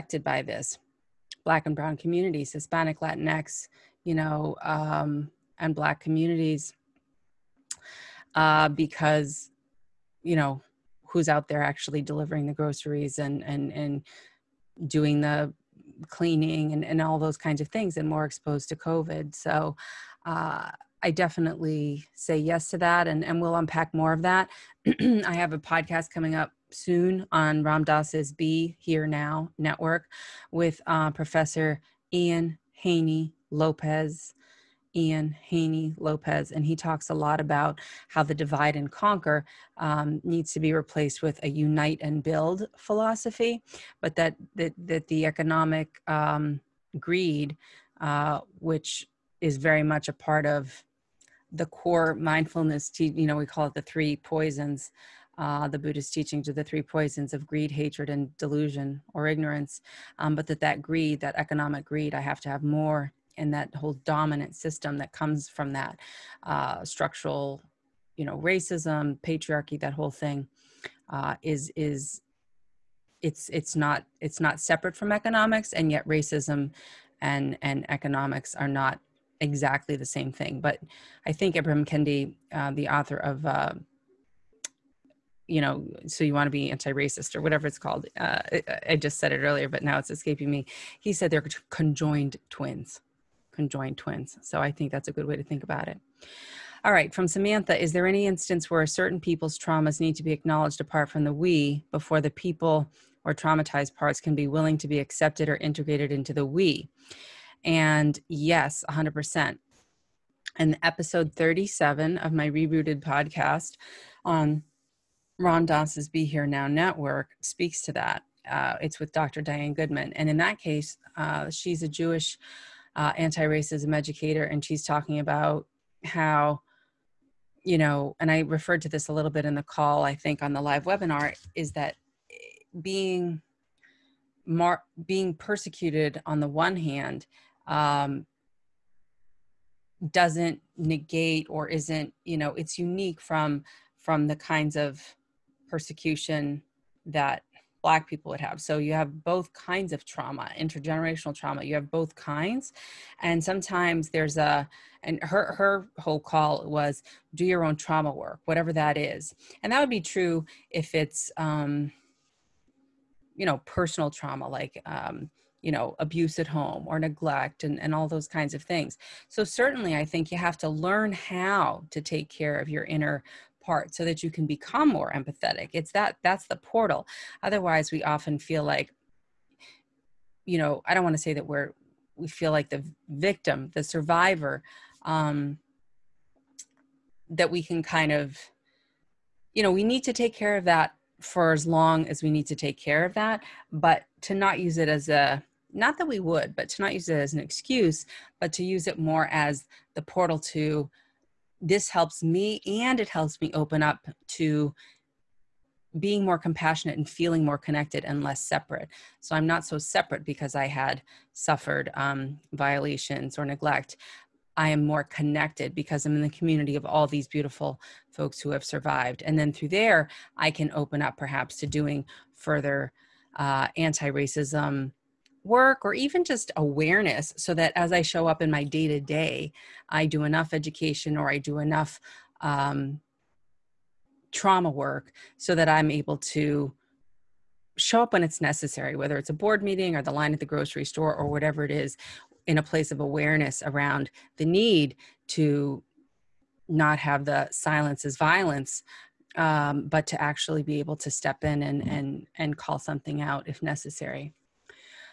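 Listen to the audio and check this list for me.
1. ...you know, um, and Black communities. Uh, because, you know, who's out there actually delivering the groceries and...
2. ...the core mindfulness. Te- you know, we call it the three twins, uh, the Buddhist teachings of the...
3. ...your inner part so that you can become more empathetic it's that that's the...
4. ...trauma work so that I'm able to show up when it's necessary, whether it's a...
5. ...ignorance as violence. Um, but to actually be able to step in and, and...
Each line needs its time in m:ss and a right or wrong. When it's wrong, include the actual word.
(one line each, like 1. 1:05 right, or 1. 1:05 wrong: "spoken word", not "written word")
1. 0:04 right
2. 0:51 wrong: "poisons", not "twins"
3. 2:52 right
4. 3:54 right
5. 4:07 wrong: "silence", not "ignorance".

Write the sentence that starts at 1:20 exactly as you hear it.
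But I think Ibrahim Kendi, uh, the author of, uh, you know, so you want to be anti-racist or whatever it's called.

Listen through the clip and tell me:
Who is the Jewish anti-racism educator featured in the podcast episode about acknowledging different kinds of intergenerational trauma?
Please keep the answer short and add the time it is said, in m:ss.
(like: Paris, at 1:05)
Dr. Diane Goodman, at 1:59.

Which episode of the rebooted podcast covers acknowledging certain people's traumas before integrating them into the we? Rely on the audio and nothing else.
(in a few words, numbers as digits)
37.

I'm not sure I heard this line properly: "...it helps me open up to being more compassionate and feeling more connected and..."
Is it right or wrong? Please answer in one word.
right.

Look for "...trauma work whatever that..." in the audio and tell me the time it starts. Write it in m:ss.
2:37.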